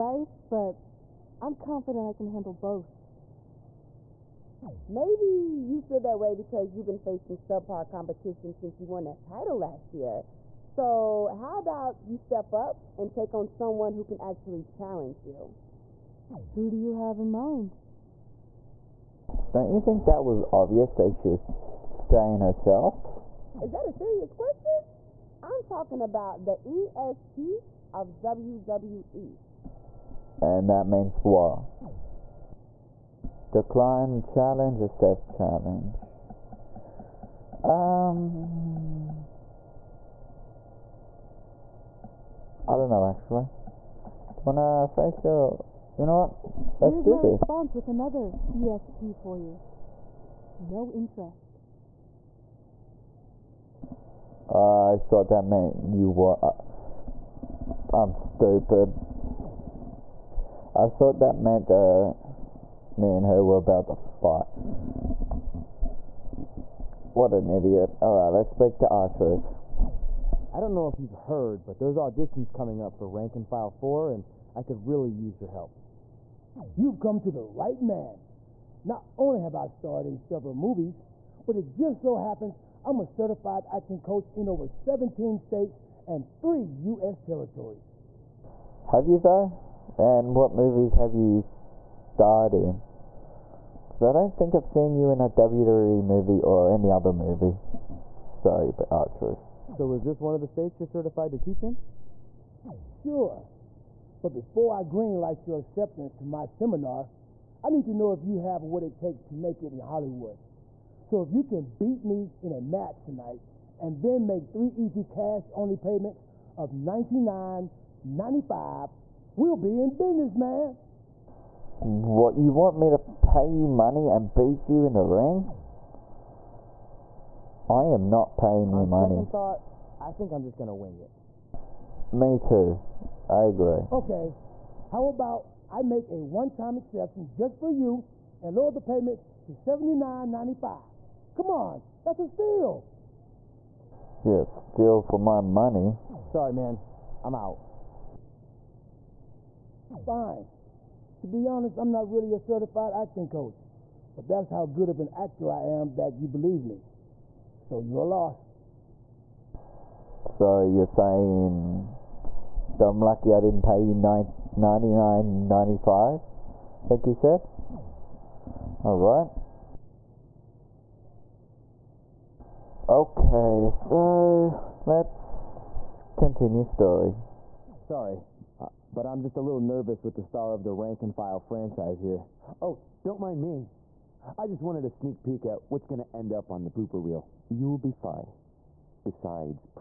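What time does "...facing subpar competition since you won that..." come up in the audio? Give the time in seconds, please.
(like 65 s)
6 s.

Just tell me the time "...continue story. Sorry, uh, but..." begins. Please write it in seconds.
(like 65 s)
176 s.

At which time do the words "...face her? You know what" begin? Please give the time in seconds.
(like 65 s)
44 s.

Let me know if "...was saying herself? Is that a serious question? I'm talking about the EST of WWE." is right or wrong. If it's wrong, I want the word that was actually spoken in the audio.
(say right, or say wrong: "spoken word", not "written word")
right.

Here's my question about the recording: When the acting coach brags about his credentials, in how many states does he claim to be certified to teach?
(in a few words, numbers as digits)
17.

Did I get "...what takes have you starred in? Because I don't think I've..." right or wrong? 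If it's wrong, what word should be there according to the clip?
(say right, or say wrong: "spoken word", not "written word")
wrong: "movies", not "takes".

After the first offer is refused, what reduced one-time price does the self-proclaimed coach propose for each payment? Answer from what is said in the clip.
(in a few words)
79.95.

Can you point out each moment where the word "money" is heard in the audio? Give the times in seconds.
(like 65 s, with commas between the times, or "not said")
123 s, 128 s, 145 s.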